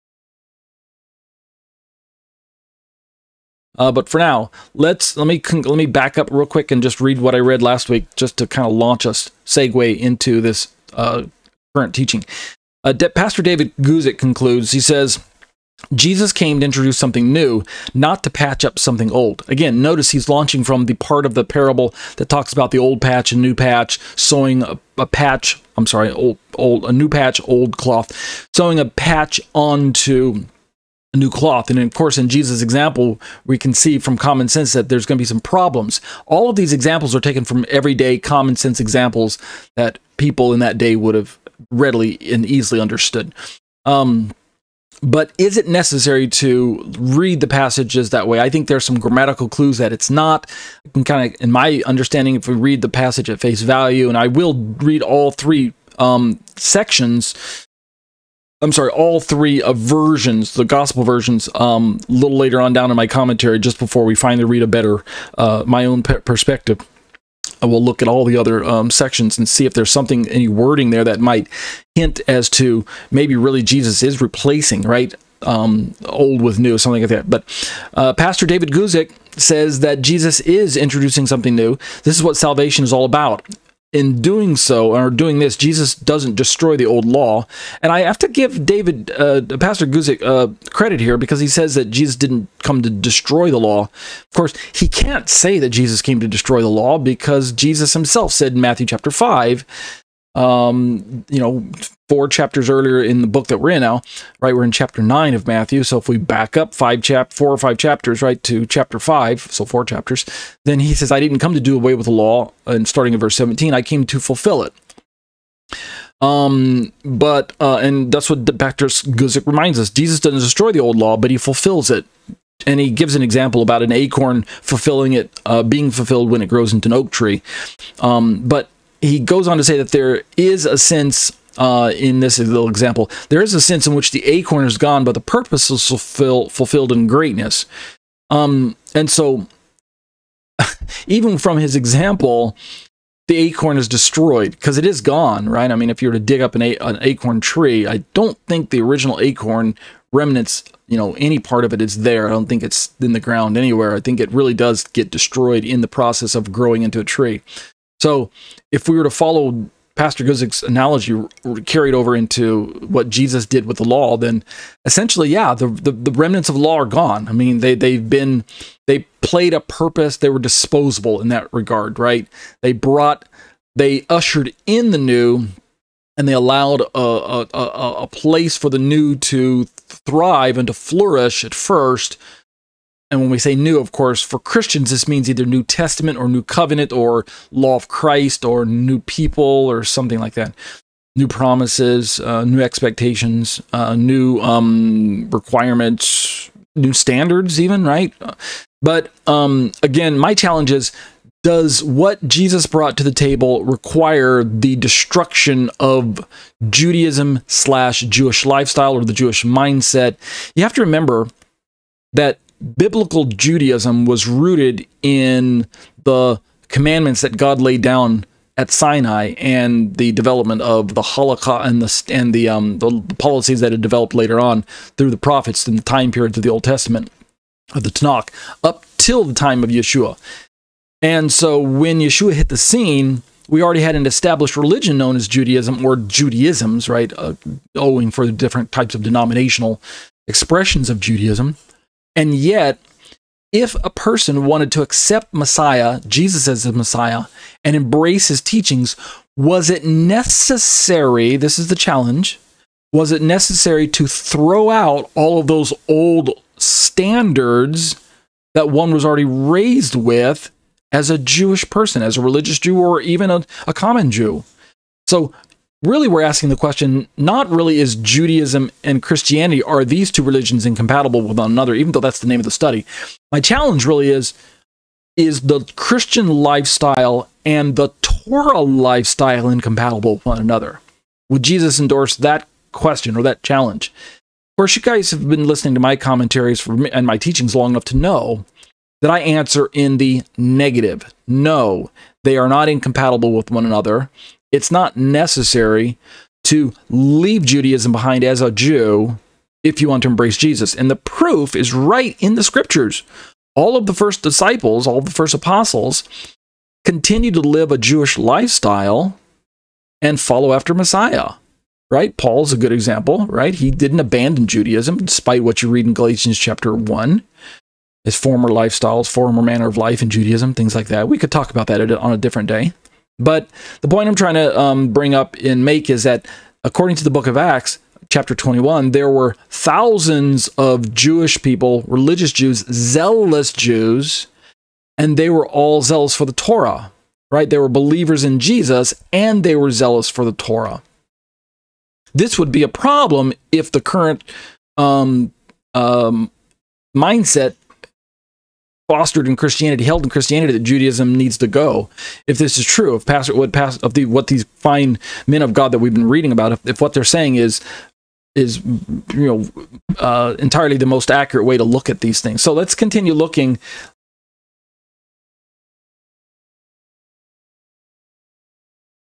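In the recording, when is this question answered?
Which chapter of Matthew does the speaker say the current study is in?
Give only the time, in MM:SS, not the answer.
01:44.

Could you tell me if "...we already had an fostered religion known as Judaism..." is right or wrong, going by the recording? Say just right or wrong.
wrong.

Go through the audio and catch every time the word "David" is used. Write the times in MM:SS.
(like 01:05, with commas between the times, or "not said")
00:13, 01:18, 01:28.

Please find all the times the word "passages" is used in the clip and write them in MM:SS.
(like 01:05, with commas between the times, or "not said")
00:47, 00:52.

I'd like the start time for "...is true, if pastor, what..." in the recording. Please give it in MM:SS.
05:52.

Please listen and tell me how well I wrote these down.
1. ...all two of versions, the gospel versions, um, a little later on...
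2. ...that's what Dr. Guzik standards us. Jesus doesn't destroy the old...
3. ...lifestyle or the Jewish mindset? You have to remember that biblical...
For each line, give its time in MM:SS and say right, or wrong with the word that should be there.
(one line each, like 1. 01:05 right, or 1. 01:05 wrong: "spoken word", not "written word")
1. 00:58 wrong: "three", not "two"
2. 01:58 wrong: "reminds", not "standards"
3. 03:28 right.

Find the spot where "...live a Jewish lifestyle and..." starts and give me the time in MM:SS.
05:07.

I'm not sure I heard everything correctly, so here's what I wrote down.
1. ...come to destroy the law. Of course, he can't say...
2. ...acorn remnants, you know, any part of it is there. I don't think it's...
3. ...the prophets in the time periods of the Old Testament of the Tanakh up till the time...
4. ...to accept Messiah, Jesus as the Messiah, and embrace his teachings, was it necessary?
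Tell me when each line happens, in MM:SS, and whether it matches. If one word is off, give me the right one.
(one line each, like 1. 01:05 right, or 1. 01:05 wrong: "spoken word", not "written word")
1. 01:32 right
2. 02:29 right
3. 03:45 right
4. 04:04 right.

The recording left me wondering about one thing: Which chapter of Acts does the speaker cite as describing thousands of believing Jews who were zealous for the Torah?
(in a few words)
Chapter 21.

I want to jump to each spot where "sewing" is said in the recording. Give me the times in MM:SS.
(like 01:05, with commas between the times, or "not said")
00:24, 00:28.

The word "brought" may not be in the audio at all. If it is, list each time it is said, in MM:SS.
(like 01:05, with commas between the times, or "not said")
02:52, 03:22.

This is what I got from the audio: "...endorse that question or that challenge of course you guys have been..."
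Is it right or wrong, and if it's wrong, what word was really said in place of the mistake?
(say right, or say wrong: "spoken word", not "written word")
right.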